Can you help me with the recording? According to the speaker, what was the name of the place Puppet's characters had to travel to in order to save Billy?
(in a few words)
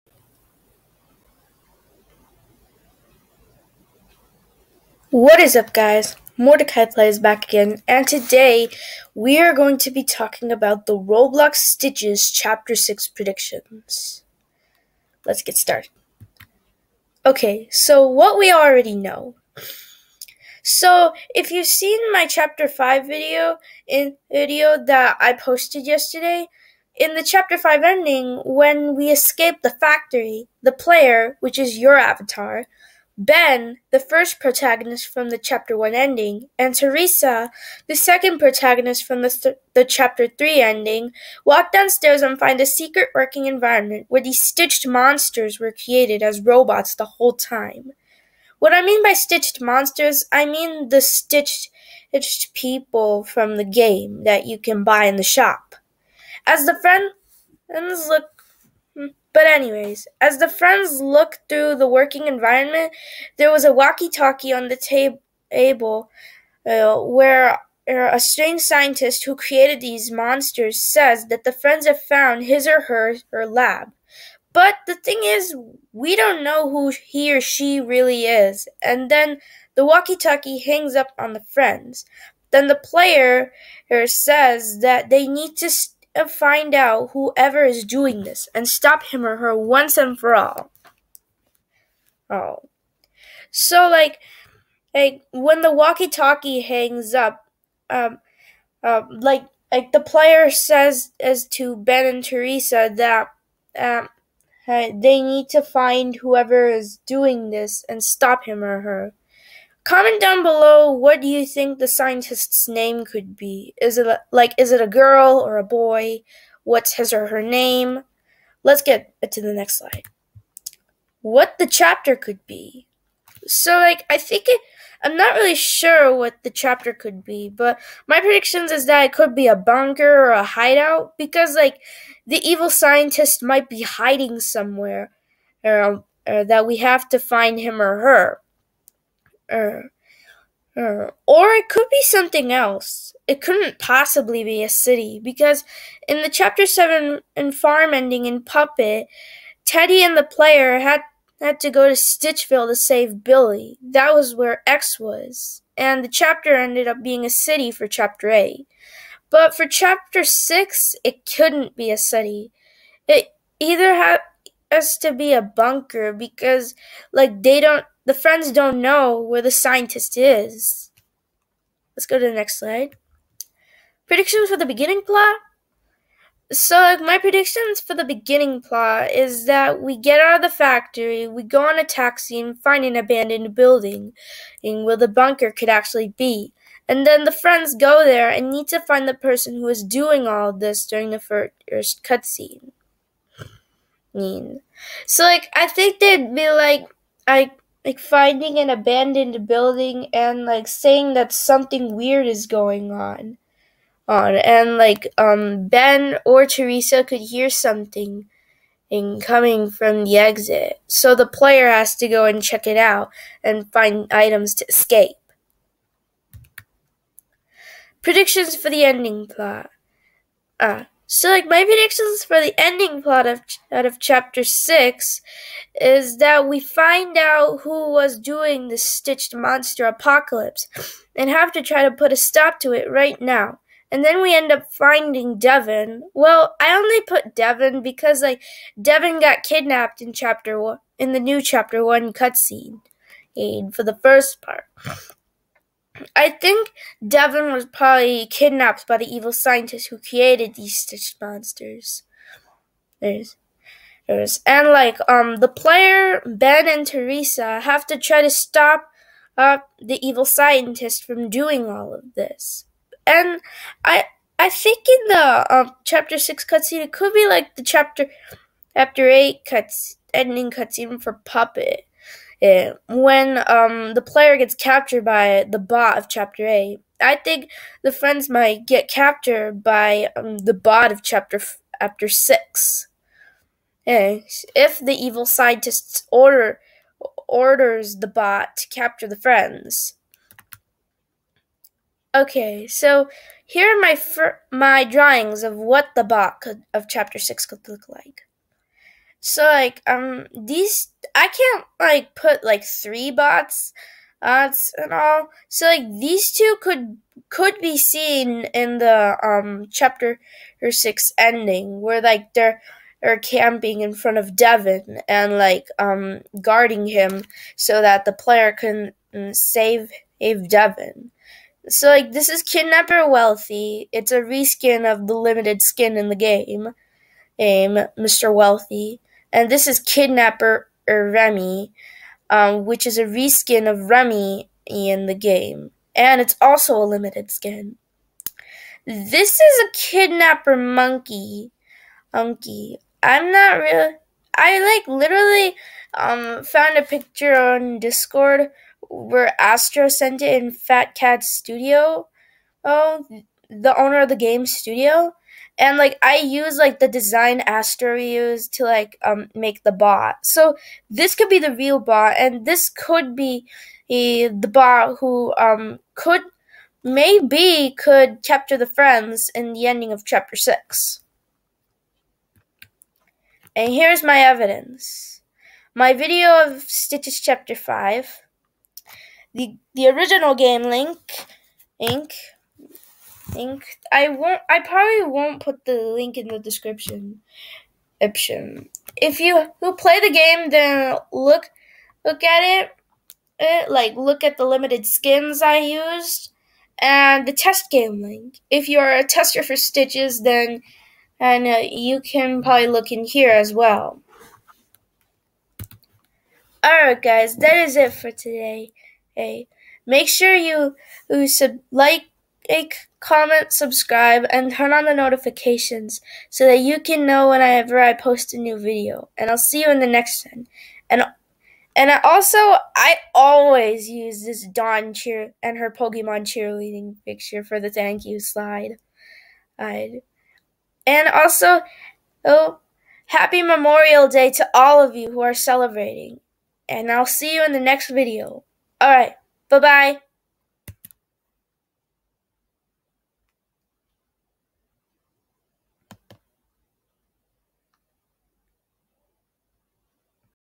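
Stitchville.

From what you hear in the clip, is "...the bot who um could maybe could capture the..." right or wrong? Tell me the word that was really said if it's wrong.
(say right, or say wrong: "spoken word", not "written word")
right.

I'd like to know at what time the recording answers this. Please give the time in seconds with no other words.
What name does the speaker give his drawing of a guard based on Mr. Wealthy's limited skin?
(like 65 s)
322 s.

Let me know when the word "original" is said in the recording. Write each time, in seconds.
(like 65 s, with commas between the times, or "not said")
379 s.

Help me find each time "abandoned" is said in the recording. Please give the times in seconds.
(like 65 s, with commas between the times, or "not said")
182 s, 198 s.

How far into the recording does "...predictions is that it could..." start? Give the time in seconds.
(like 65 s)
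128 s.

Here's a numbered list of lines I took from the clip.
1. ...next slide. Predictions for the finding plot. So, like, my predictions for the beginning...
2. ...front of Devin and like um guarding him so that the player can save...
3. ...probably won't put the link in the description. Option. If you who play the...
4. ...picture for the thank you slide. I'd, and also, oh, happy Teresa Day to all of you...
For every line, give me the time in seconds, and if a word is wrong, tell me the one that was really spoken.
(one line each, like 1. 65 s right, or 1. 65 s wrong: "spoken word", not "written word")
1. 172 s wrong: "beginning", not "finding"
2. 313 s right
3. 384 s right
4. 427 s wrong: "Memorial", not "Teresa".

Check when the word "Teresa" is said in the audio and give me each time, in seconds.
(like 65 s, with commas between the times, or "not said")
36 s, 102 s, 206 s, 256 s.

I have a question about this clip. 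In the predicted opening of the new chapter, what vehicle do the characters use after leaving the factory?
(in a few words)
a taxi.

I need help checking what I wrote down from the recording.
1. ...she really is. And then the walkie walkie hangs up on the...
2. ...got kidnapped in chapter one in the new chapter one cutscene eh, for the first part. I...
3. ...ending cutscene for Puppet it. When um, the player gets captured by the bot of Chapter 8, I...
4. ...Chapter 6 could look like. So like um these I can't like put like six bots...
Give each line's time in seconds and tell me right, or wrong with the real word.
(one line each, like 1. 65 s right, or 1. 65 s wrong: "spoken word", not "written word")
1. 77 s wrong: "talkie", not "walkie"
2. 239 s right
3. 270 s right
4. 296 s wrong: "three", not "six".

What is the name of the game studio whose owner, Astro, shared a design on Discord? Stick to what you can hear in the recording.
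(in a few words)
Fat Cat Studio.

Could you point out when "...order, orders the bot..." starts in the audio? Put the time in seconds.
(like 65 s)
286 s.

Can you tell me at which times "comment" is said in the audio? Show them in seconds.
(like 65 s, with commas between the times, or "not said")
109 s, 412 s.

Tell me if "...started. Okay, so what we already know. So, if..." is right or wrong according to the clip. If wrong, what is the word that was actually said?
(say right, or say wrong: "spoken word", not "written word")
right.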